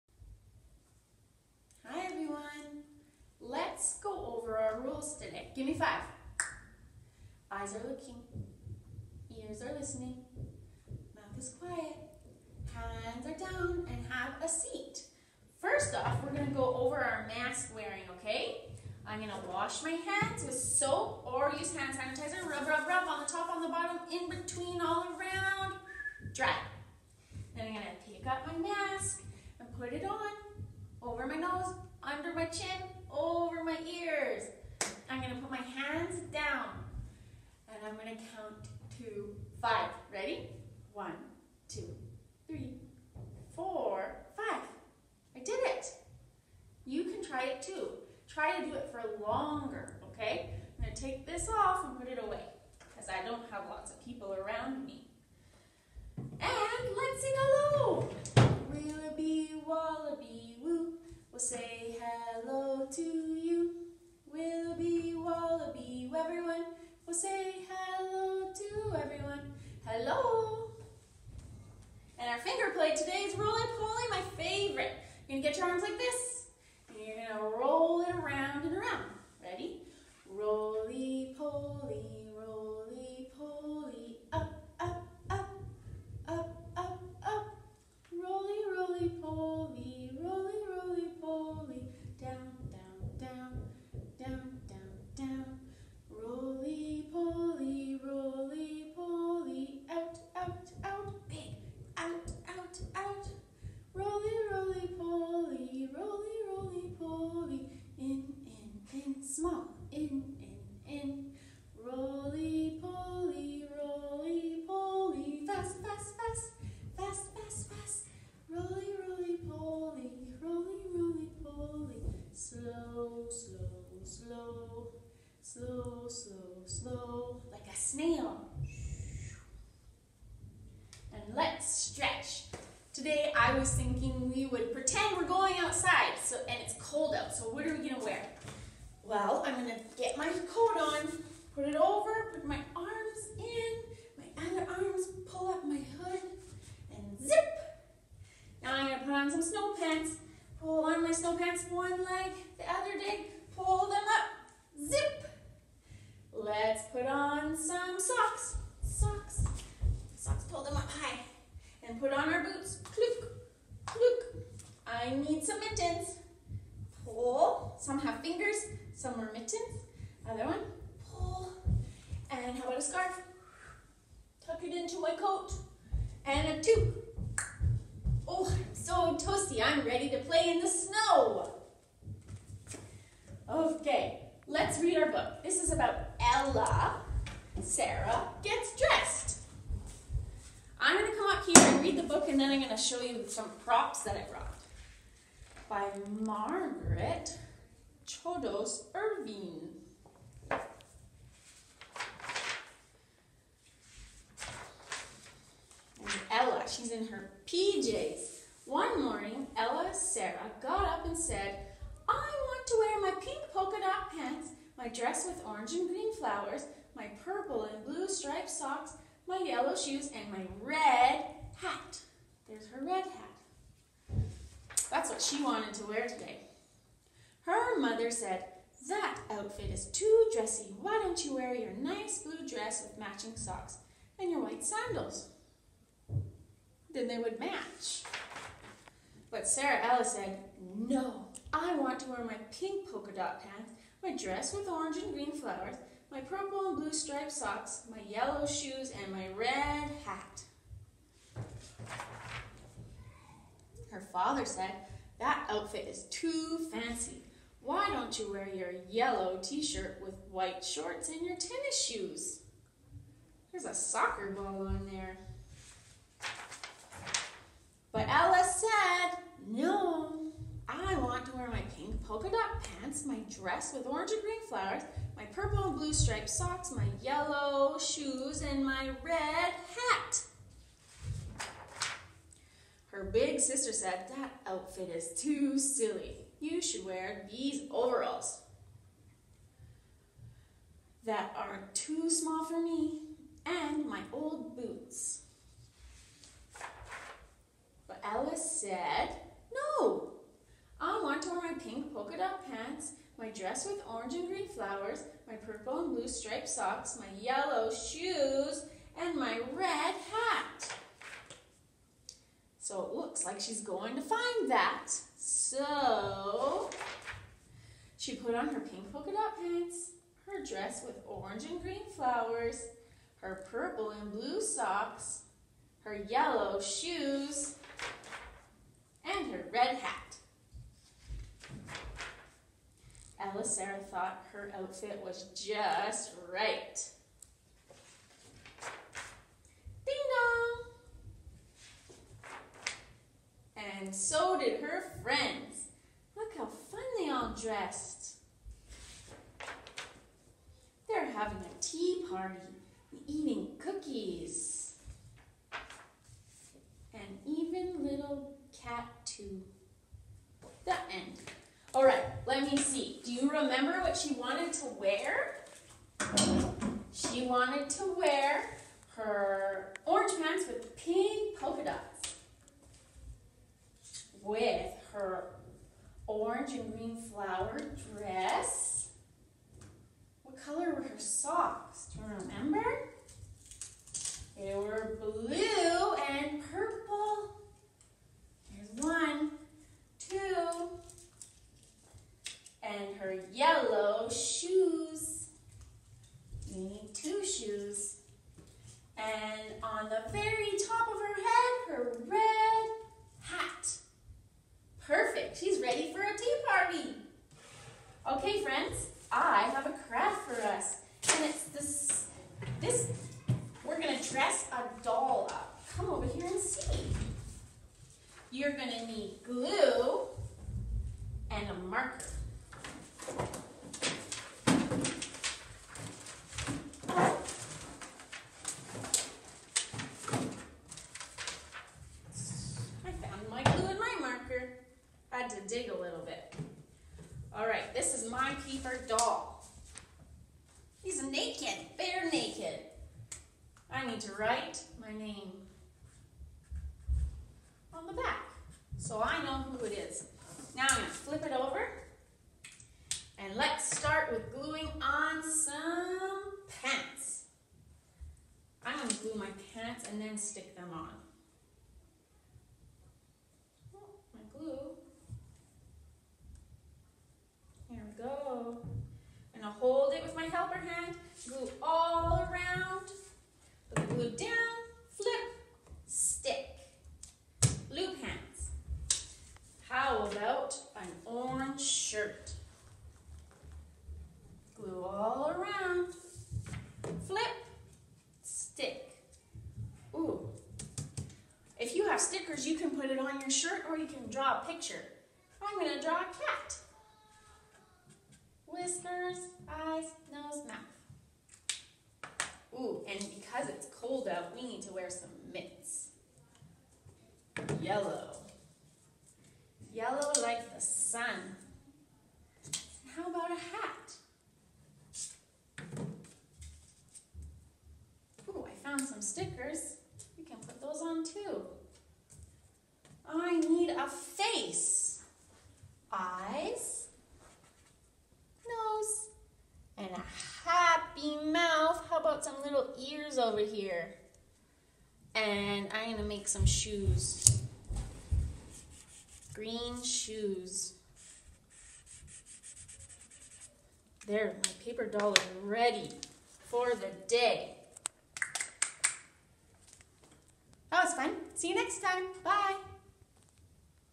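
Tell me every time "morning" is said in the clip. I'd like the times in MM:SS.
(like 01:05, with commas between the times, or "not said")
03:29.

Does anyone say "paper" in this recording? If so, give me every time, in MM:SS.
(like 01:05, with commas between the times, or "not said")
07:18, 09:04.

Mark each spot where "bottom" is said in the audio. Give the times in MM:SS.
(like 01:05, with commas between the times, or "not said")
00:23.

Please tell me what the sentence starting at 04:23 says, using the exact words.
There's a soccer ball on there.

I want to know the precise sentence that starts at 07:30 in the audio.
Now I'm going to flip it over.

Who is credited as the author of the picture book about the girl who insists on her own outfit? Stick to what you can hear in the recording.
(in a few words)
Margaret Chodos Irving.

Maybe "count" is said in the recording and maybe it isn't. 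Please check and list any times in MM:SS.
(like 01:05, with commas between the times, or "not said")
00:38.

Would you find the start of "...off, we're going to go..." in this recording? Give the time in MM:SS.
00:15.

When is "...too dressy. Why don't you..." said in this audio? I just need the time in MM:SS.
03:49.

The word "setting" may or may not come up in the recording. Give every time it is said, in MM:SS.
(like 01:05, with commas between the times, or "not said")
not said.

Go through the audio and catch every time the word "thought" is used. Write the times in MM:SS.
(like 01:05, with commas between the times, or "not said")
05:33.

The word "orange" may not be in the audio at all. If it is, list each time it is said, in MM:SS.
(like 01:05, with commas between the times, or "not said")
03:35, 04:04, 04:33, 05:03, 05:21, 06:09, 06:16.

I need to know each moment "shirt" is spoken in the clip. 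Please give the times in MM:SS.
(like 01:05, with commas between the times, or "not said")
04:19, 08:13.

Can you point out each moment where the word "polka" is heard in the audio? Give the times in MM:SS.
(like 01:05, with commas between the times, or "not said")
03:33, 04:02, 04:32, 05:01, 05:18, 06:11.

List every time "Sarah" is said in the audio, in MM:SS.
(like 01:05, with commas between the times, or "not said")
03:07, 03:29, 03:59, 05:33.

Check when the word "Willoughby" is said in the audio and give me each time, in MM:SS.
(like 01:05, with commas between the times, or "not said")
00:58, 01:04.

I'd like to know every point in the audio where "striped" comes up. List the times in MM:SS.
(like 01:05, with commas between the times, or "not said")
03:38, 04:06, 04:35, 05:06.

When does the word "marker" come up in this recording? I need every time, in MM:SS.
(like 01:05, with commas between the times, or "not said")
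07:01, 07:13.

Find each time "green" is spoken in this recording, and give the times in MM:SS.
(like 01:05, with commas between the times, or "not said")
03:35, 04:05, 04:34, 05:04, 05:21, 06:16, 08:59.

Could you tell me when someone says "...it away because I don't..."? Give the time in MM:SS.
00:52.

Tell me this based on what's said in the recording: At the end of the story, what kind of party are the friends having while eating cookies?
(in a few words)
Tea party.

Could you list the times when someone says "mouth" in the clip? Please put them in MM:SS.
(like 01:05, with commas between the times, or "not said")
00:11, 08:20, 08:51.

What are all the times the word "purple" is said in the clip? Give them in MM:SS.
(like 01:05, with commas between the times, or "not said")
03:37, 04:06, 04:35, 05:05, 05:23, 06:26.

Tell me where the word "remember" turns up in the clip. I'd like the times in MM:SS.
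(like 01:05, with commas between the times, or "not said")
06:03, 06:22.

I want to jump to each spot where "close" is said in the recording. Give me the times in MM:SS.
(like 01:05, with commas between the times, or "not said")
00:05.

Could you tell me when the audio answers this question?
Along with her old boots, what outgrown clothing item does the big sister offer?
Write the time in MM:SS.
04:47.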